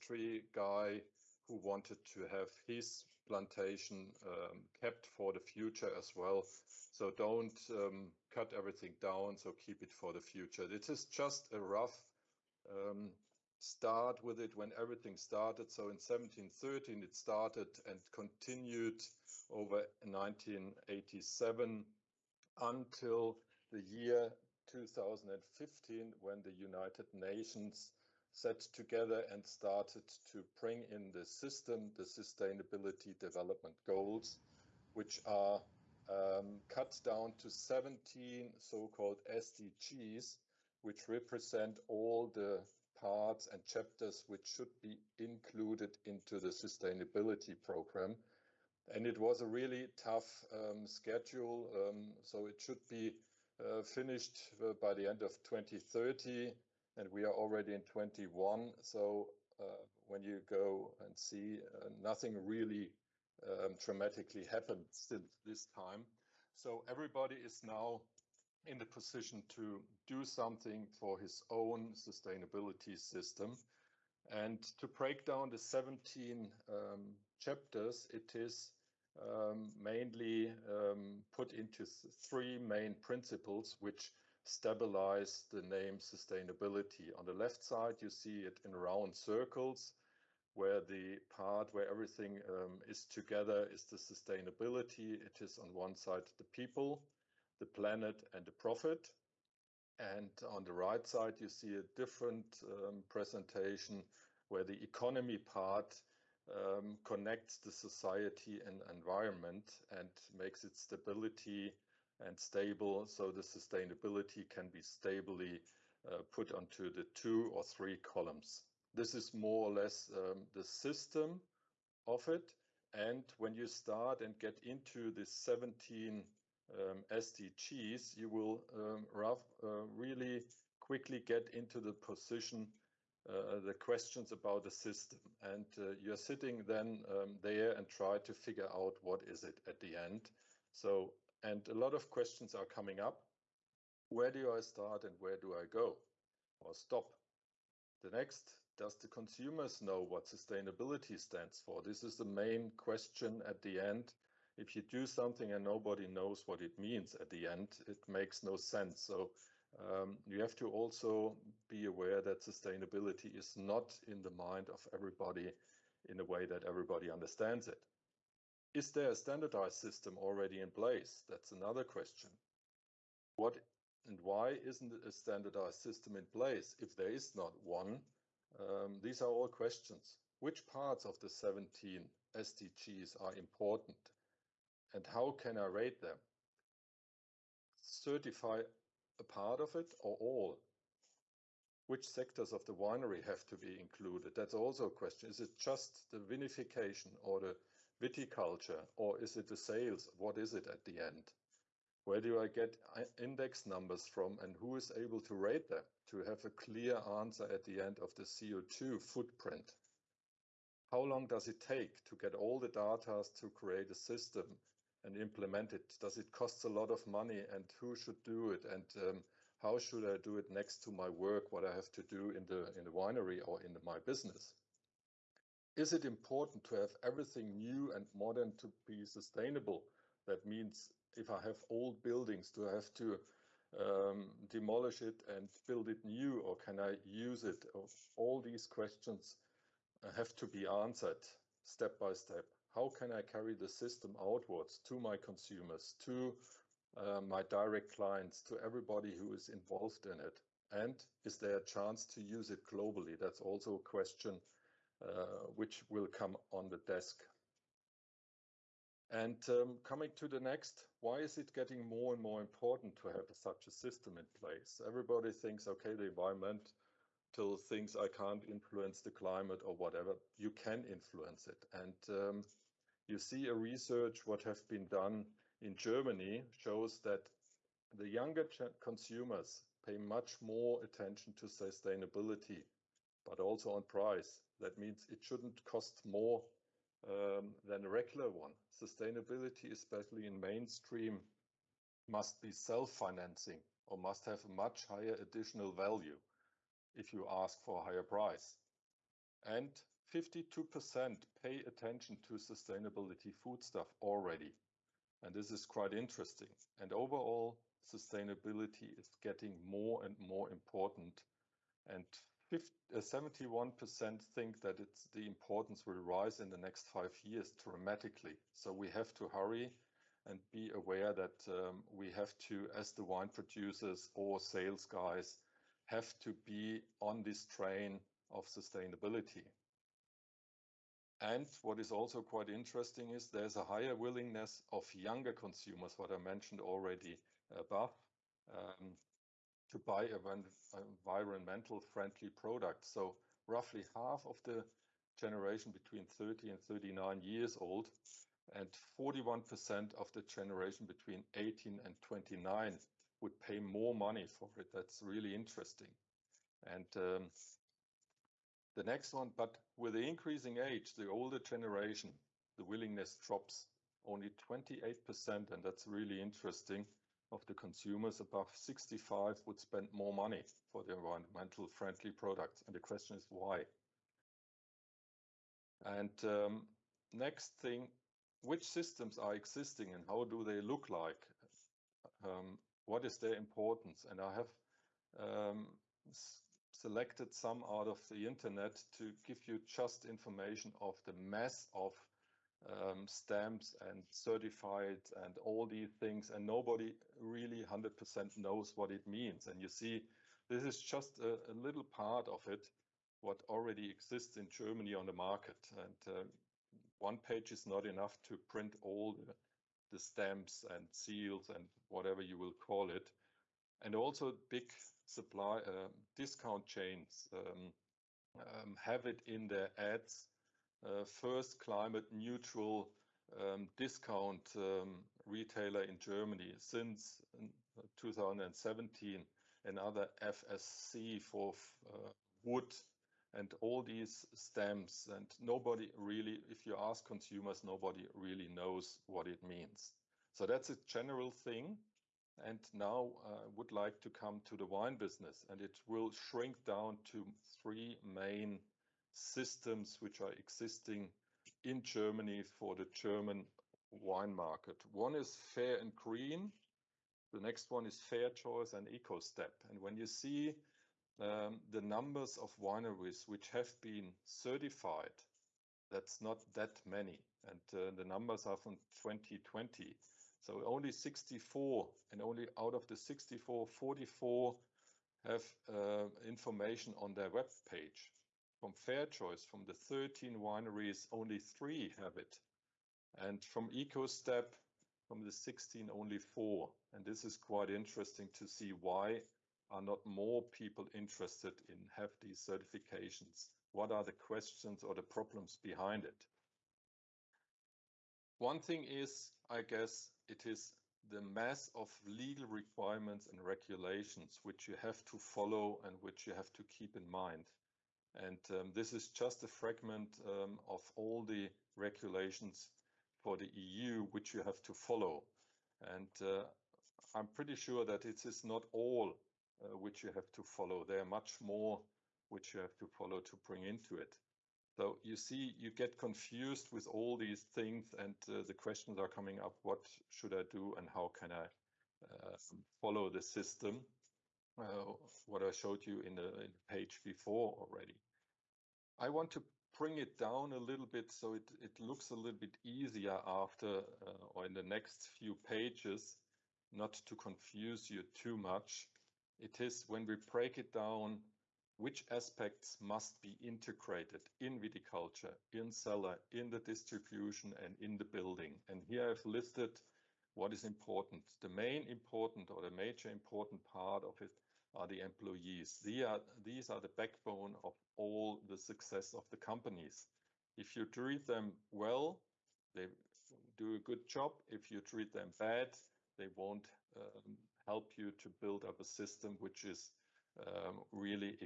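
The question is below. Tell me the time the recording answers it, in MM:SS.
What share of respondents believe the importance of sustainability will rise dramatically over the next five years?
05:12.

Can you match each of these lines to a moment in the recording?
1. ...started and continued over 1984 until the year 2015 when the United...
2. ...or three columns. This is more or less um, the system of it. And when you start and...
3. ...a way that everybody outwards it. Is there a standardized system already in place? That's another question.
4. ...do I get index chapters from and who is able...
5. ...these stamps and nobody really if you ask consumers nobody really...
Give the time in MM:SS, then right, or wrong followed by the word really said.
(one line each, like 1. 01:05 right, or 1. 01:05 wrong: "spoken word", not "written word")
1. 00:17 wrong: "1987", not "1984"
2. 01:57 right
3. 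02:46 wrong: "understands", not "outwards"
4. 03:22 wrong: "numbers", not "chapters"
5. 07:13 right.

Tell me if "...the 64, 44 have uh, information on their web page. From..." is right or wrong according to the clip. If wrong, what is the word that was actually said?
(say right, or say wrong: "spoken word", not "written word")
right.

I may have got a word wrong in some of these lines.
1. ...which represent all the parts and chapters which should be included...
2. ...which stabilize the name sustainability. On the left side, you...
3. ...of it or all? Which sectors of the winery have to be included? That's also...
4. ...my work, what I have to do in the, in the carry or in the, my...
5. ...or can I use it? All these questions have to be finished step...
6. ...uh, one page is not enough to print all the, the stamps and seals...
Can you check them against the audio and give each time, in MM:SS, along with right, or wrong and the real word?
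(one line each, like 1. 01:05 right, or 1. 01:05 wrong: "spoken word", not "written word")
1. 00:40 right
2. 01:23 right
3. 03:09 right
4. 03:40 wrong: "winery", not "carry"
5. 03:56 wrong: "answered", not "finished"
6. 06:46 right.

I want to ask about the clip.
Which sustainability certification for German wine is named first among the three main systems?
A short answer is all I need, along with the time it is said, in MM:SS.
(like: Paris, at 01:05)
Fair and Green, at 07:35.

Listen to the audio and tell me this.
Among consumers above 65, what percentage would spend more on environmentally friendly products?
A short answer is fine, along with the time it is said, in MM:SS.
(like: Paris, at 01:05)
28%, at 06:04.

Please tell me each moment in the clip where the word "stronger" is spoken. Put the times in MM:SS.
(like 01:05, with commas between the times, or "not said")
not said.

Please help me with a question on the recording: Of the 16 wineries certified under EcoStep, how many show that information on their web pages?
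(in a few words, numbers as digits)
4.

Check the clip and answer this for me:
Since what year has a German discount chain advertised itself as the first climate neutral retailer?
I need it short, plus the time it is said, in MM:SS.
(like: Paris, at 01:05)
2017, at 07:07.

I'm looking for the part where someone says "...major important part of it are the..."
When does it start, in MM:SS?
09:22.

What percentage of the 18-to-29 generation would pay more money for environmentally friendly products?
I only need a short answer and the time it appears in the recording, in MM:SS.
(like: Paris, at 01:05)
41%, at 05:48.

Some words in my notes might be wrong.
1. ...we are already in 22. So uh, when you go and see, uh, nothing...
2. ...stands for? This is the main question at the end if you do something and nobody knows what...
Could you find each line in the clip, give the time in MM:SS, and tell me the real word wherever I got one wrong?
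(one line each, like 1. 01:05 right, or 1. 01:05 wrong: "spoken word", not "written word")
1. 00:57 wrong: "21", not "22"
2. 02:31 right.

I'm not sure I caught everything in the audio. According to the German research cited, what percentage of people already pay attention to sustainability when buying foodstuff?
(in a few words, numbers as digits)
52%.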